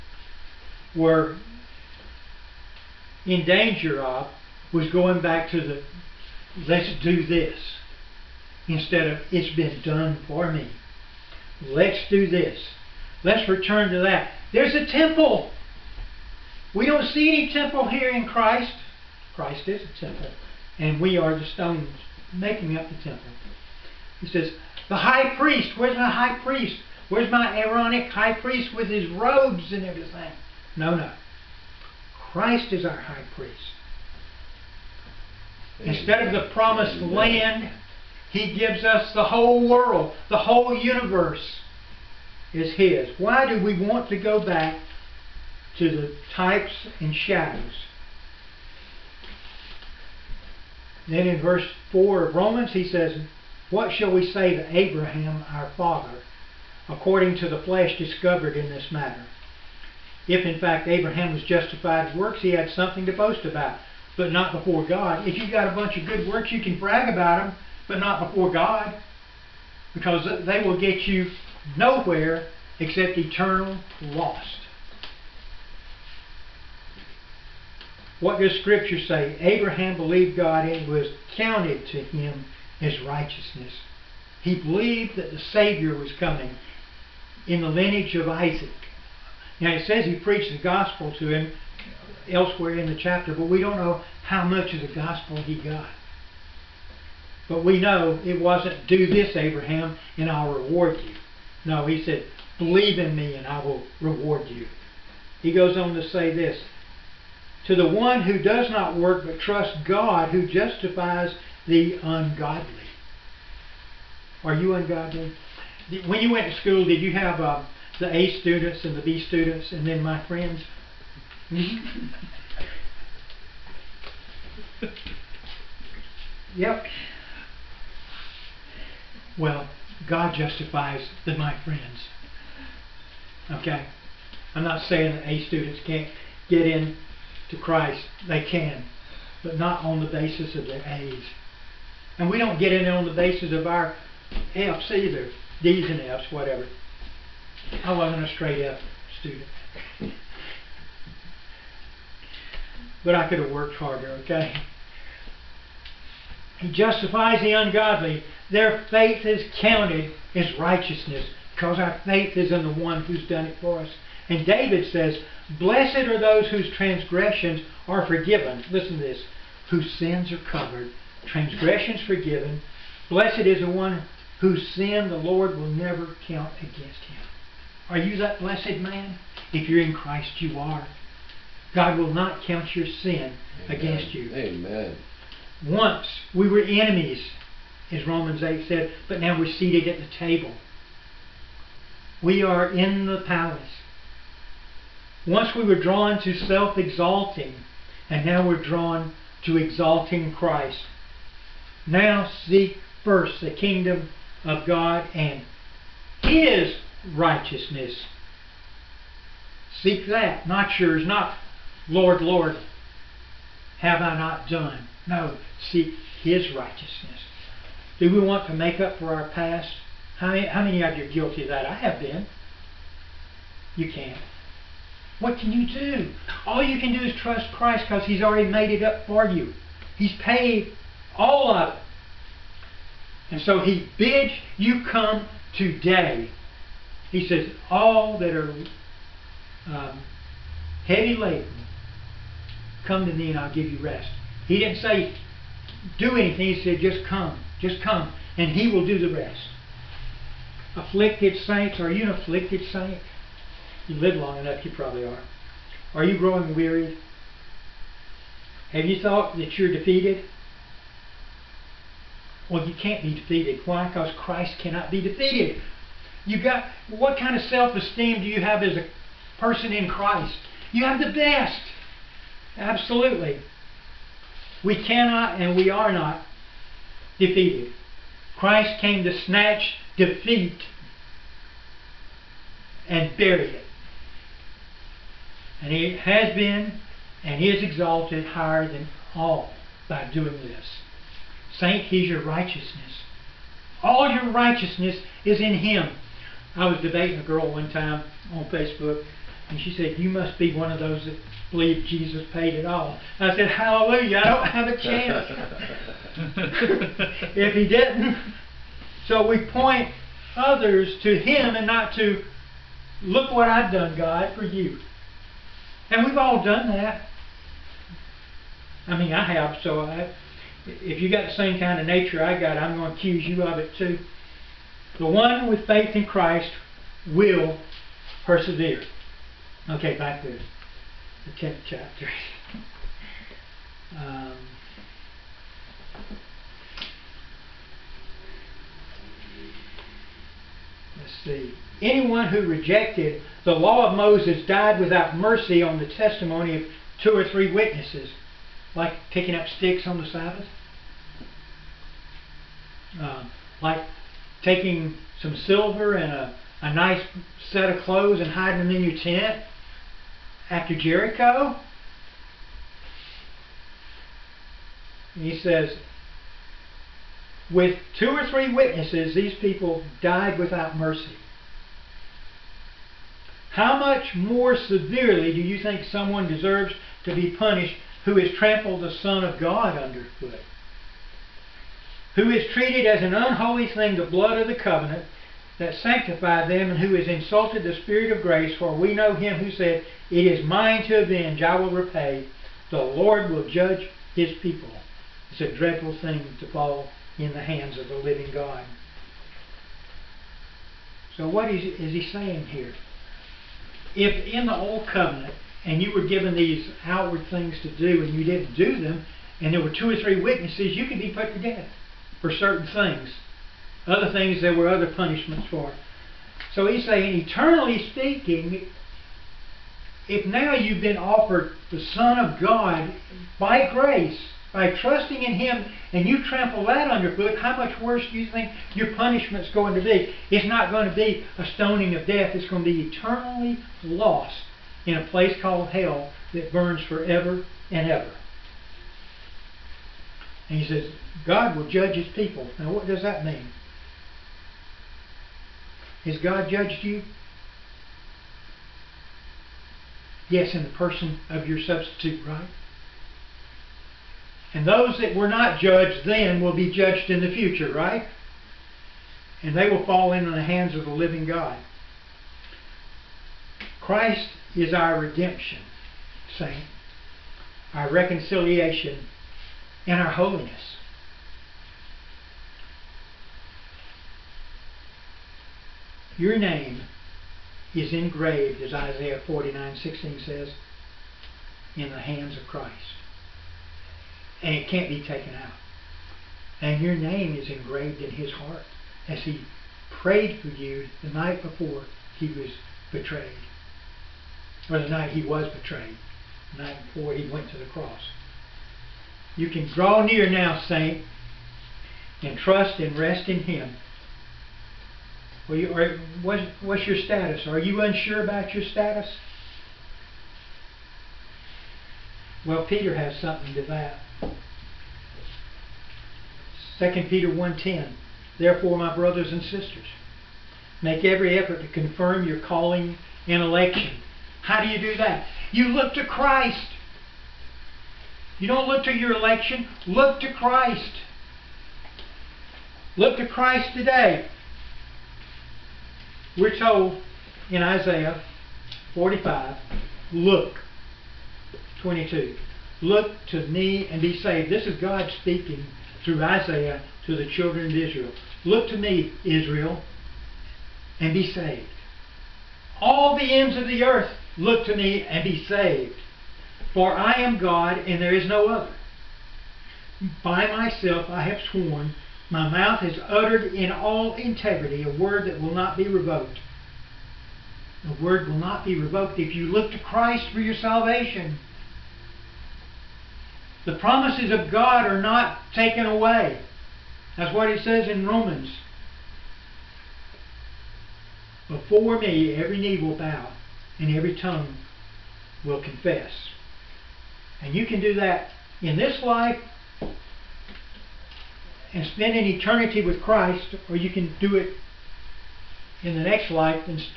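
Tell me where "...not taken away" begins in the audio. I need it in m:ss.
9:34.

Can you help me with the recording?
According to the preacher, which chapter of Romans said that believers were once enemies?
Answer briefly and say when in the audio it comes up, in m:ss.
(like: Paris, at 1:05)
Romans 8, at 3:08.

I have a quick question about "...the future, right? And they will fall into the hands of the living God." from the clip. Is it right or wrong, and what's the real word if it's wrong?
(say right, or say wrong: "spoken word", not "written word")
right.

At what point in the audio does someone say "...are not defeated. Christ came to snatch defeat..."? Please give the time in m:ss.
4:35.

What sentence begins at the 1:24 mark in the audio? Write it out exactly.
He believed that the Savior was coming in the lineage of Isaac.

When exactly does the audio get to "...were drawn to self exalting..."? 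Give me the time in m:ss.
3:15.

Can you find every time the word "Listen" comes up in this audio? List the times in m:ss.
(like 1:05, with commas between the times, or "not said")
2:48.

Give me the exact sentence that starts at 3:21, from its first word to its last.
Now seek first the kingdom of God and His righteousness.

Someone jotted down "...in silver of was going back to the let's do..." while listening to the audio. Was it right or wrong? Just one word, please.
wrong.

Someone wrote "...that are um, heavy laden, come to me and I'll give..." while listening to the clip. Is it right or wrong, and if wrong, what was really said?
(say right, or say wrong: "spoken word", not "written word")
right.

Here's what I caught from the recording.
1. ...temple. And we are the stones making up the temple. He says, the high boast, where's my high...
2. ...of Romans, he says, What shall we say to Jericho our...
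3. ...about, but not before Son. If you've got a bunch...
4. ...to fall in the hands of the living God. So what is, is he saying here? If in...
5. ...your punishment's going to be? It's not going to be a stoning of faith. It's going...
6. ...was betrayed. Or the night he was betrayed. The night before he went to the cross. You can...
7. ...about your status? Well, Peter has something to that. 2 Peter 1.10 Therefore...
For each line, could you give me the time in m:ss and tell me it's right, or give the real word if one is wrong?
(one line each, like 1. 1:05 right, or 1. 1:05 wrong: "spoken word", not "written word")
1. 0:19 wrong: "priest", not "boast"
2. 0:52 wrong: "Abraham", not "Jericho"
3. 1:03 wrong: "God", not "Son"
4. 6:36 right
5. 7:08 wrong: "death", not "faith"
6. 8:12 right
7. 8:28 right.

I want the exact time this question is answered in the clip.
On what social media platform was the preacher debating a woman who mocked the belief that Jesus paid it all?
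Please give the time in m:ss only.
4:58.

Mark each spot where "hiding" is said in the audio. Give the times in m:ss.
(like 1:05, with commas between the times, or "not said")
5:58.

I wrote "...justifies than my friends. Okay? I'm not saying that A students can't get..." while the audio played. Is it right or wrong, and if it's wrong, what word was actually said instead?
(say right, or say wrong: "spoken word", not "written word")
right.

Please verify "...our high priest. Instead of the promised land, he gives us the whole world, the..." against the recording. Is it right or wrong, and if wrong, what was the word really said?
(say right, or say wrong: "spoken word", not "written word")
right.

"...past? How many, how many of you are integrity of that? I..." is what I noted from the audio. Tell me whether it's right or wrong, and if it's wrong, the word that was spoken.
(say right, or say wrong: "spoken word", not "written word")
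wrong: "guilty", not "integrity".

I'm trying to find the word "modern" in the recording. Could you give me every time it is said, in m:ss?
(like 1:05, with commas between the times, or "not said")
not said.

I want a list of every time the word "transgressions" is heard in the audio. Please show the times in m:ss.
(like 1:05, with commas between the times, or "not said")
2:46, 2:51.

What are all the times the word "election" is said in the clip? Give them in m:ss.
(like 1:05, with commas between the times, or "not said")
8:43, 8:49.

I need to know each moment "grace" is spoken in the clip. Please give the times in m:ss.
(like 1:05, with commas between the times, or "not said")
6:28, 7:03.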